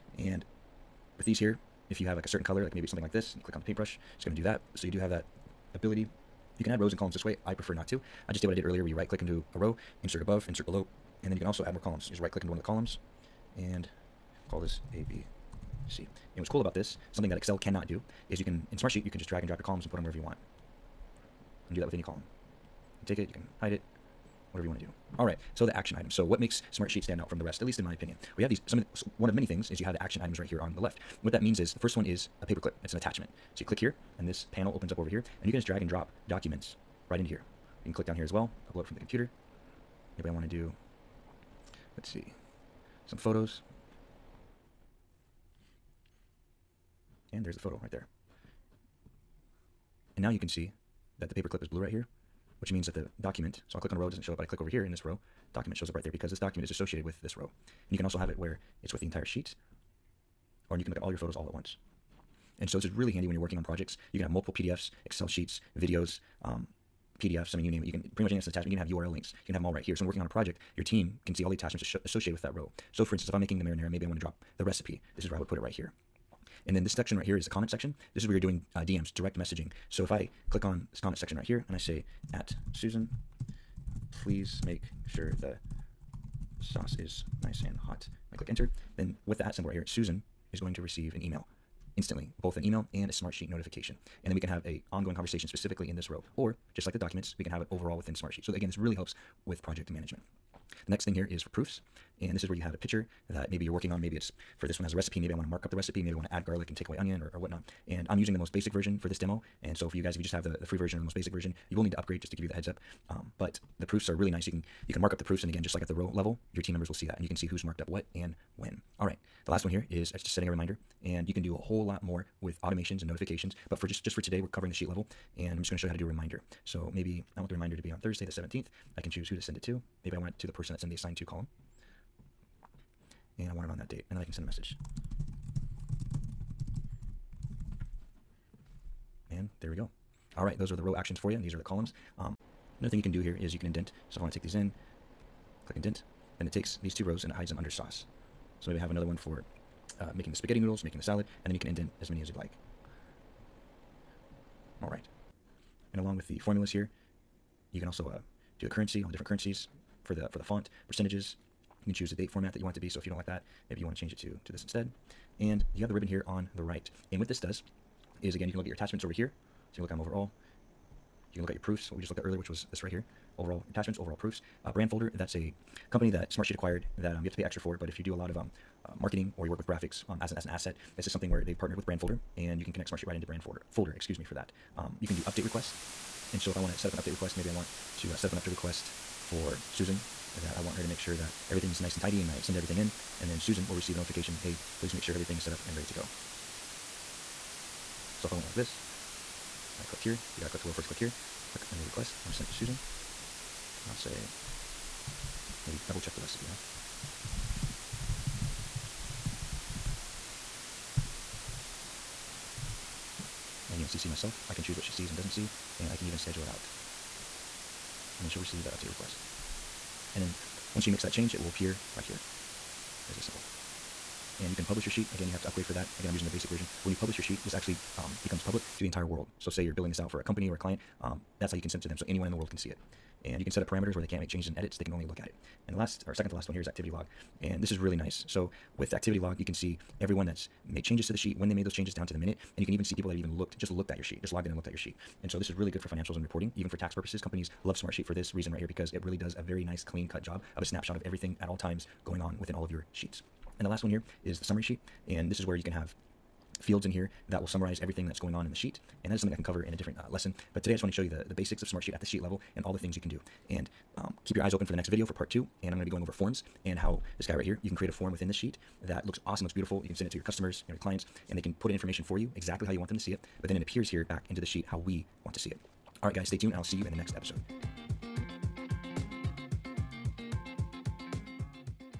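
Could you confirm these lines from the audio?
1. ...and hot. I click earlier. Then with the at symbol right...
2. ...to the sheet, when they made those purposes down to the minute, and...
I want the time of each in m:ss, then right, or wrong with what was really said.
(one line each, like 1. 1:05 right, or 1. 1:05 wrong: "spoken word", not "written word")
1. 1:27 wrong: "enter", not "earlier"
2. 4:01 wrong: "changes", not "purposes".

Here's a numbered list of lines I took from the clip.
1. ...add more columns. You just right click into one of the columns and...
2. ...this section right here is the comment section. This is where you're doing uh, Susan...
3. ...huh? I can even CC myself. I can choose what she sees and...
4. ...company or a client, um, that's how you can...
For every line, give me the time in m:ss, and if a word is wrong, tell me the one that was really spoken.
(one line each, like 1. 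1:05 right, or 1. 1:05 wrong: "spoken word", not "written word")
1. 0:11 right
2. 1:16 wrong: "DMs", not "Susan"
3. 3:26 right
4. 3:50 right.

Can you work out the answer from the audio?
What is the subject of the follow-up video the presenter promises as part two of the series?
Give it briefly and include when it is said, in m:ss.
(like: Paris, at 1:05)
forms, at 4:26.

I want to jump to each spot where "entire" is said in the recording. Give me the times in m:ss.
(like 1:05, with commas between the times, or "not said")
0:59, 3:48.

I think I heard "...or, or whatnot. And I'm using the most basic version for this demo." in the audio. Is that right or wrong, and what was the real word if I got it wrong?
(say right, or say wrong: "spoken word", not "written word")
right.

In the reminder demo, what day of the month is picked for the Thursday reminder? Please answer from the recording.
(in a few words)
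17.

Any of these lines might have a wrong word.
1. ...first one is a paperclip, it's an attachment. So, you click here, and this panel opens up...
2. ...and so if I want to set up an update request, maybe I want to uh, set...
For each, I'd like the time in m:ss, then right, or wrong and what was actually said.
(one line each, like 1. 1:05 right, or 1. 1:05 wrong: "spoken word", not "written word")
1. 0:31 right
2. 3:06 right.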